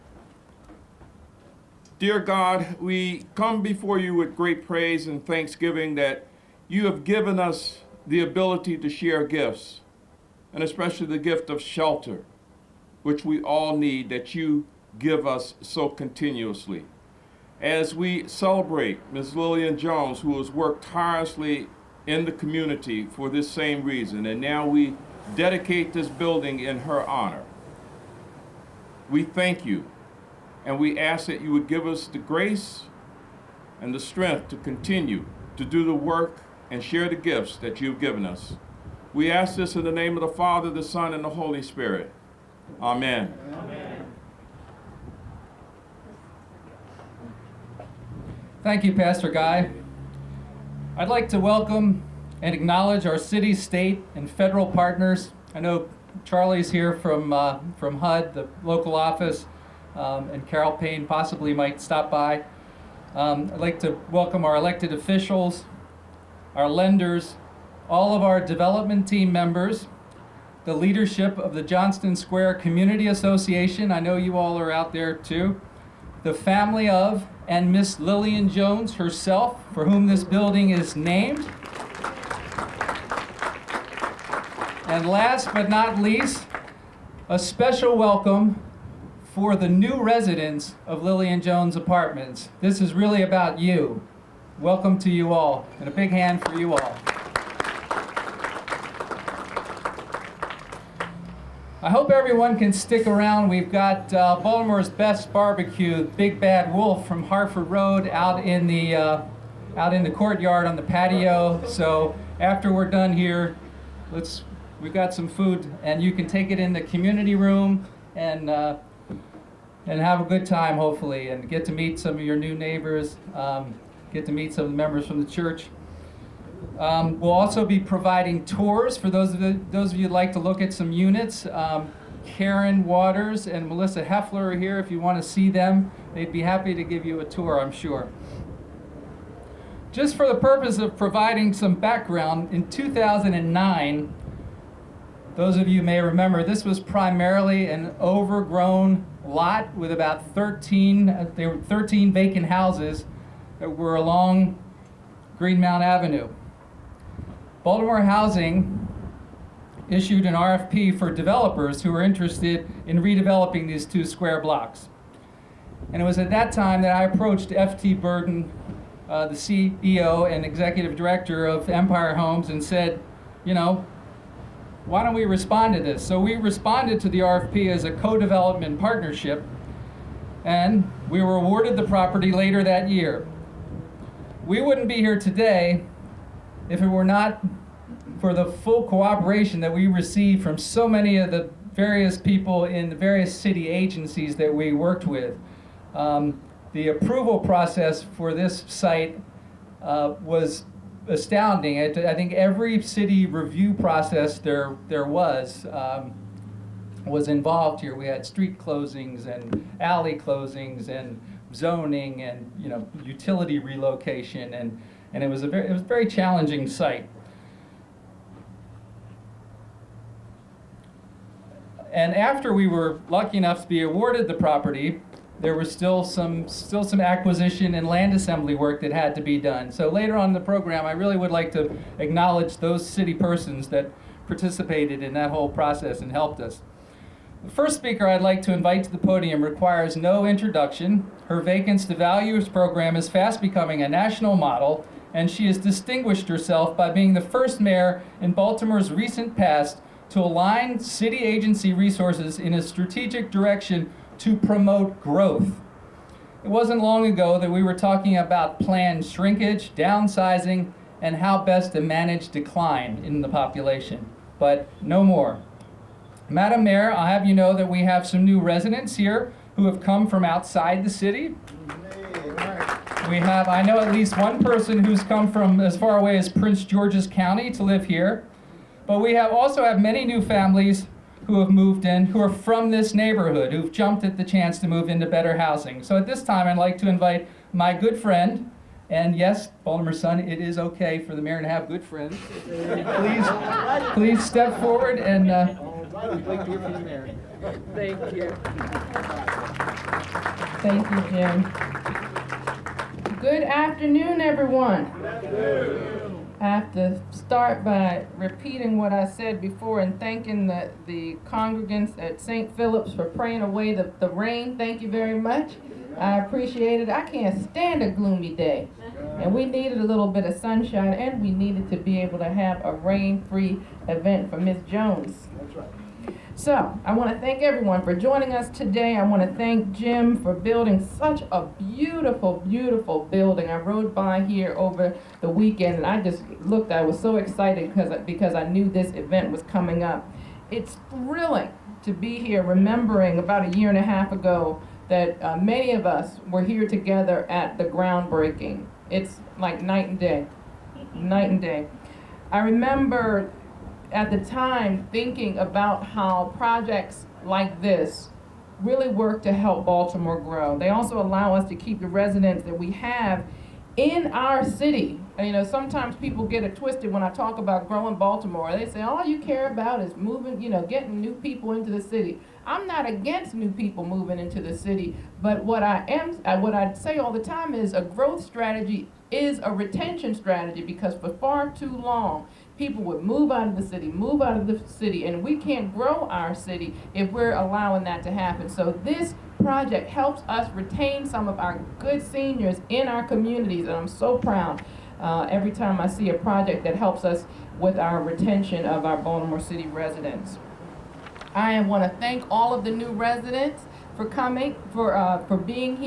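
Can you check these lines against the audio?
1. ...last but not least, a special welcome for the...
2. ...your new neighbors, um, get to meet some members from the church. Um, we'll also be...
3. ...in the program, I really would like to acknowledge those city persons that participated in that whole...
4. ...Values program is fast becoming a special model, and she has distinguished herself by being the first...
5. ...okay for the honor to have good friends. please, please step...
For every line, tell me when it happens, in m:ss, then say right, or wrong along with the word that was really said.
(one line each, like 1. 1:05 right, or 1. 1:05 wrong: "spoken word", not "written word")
1. 1:25 right
2. 2:02 right
3. 3:50 right
4. 4:01 wrong: "national", not "special"
5. 4:50 wrong: "mayor", not "honor".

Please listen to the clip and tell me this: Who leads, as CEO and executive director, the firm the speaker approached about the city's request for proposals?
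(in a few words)
F.T. Burden.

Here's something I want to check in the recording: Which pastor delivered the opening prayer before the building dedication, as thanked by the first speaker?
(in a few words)
Pastor Guy.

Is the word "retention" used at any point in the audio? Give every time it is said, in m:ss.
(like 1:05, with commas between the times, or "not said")
6:19, 6:38.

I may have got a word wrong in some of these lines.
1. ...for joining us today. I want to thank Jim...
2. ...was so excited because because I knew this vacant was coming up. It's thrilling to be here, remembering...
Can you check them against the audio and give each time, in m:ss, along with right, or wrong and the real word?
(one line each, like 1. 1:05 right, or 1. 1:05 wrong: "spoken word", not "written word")
1. 5:27 right
2. 5:36 wrong: "event", not "vacant".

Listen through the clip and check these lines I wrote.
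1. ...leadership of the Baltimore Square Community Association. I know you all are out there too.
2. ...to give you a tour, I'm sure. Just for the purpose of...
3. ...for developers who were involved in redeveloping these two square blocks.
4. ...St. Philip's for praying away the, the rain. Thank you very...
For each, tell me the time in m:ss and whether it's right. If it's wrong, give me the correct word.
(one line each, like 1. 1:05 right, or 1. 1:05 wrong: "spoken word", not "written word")
1. 1:10 wrong: "Johnston", not "Baltimore"
2. 2:16 right
3. 2:40 wrong: "interested", not "involved"
4. 5:12 right.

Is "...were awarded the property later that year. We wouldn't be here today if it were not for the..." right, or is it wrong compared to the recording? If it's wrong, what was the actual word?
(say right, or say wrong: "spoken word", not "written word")
right.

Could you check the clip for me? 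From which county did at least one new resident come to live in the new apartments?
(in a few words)
Prince George's County.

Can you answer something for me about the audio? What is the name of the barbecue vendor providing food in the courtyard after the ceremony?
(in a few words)
Big Bad Wolf.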